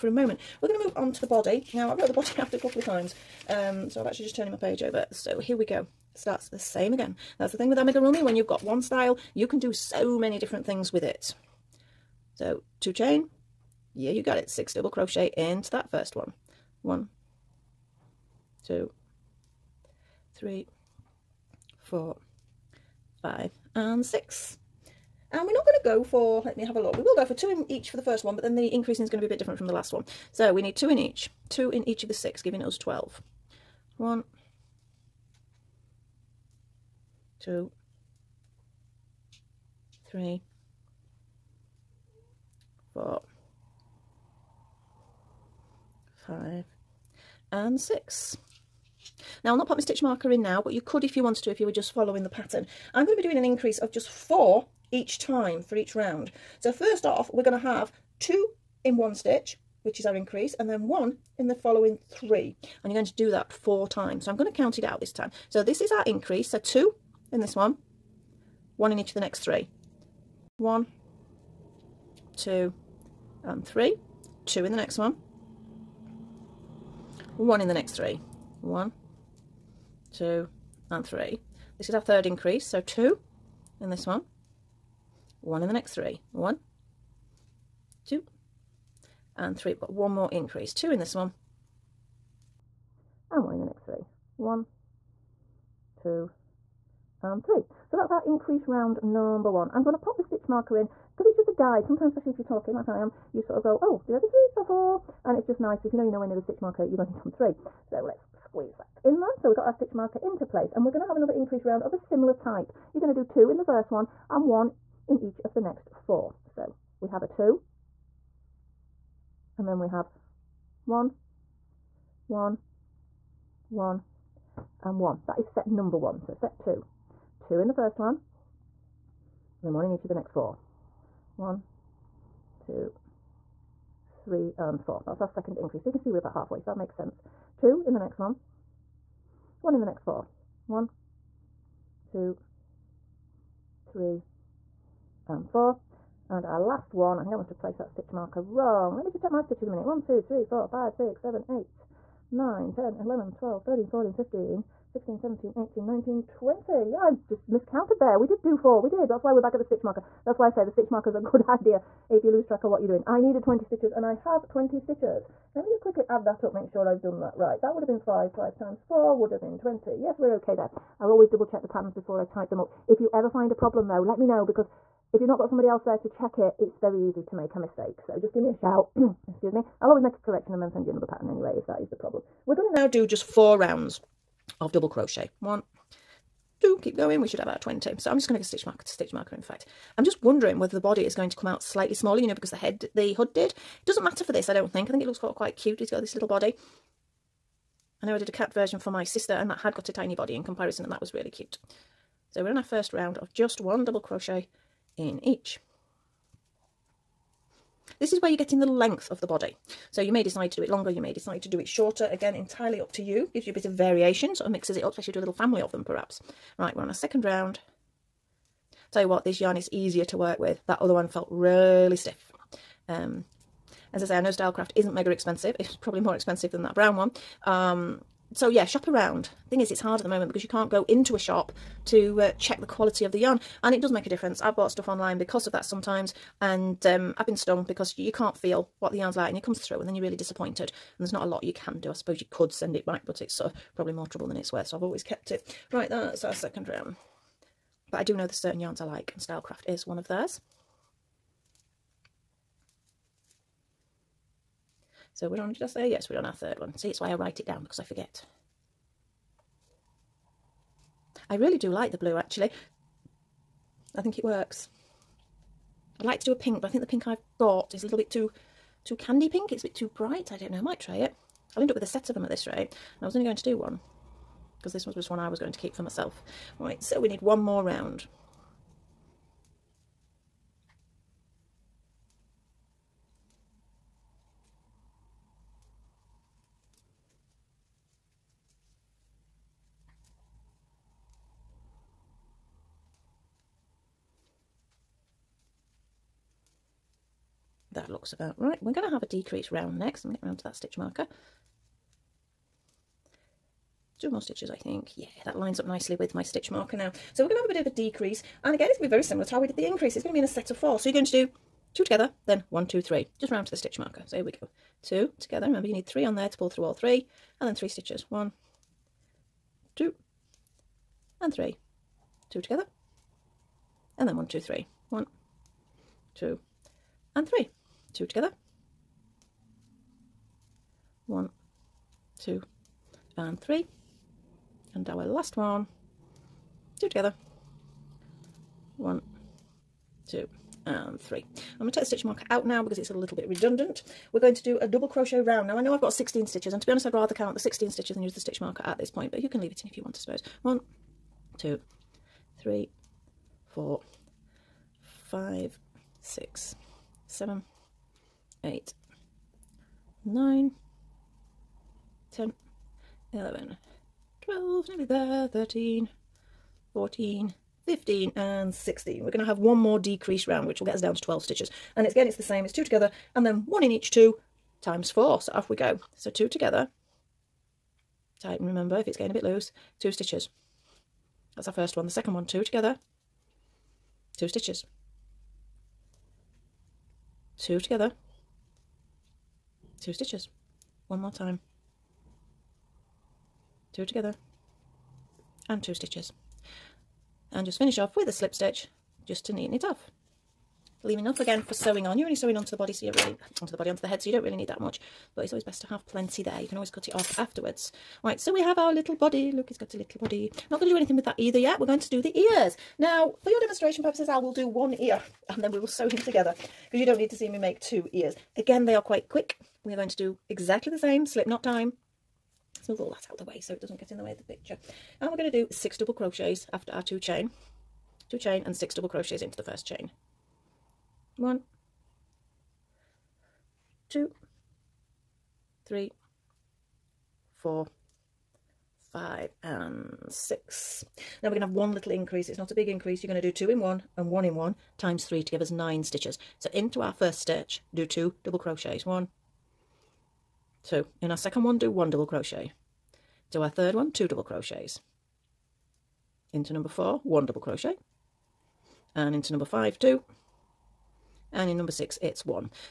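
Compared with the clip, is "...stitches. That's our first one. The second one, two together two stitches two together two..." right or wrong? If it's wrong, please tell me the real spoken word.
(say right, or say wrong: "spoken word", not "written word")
right.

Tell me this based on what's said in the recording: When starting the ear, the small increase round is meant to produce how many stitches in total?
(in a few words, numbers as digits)
9.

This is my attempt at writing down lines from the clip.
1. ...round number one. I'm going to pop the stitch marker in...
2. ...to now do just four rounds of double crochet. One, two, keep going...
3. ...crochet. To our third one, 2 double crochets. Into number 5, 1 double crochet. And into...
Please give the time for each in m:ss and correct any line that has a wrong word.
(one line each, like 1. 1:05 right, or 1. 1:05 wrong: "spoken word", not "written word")
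1. 1:38 right
2. 3:02 right
3. 7:32 wrong: "4", not "5".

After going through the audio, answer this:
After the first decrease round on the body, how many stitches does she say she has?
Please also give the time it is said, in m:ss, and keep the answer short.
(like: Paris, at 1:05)
16, at 5:45.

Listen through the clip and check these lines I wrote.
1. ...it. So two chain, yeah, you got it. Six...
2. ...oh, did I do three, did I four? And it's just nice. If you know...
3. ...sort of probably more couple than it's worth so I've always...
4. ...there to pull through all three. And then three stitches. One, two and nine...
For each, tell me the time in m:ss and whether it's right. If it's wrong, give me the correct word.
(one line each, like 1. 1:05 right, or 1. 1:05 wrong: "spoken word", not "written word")
1. 0:11 right
2. 1:43 right
3. 4:03 wrong: "trouble", not "couple"
4. 5:16 wrong: "three", not "nine".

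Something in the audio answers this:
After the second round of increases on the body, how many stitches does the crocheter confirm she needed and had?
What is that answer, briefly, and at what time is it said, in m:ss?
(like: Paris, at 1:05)
20, at 2:43.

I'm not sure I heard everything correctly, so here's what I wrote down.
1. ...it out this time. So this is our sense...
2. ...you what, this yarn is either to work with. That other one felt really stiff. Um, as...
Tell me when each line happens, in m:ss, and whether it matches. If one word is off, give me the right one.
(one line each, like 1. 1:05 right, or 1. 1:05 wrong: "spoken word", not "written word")
1. 1:04 wrong: "increase", not "sense"
2. 3:39 wrong: "easier", not "either".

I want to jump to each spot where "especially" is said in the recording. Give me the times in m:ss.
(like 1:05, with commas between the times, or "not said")
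1:42, 3:34.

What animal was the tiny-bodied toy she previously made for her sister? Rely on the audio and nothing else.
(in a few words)
cat.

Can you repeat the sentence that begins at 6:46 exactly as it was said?
You can always cut it off afterwards.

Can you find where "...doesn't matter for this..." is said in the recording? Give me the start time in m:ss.
3:13.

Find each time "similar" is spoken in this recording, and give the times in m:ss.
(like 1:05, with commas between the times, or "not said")
1:51, 5:09.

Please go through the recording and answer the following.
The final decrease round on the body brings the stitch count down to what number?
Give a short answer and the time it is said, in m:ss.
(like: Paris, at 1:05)
12, at 6:11.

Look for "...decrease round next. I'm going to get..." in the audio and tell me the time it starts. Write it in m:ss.
4:59.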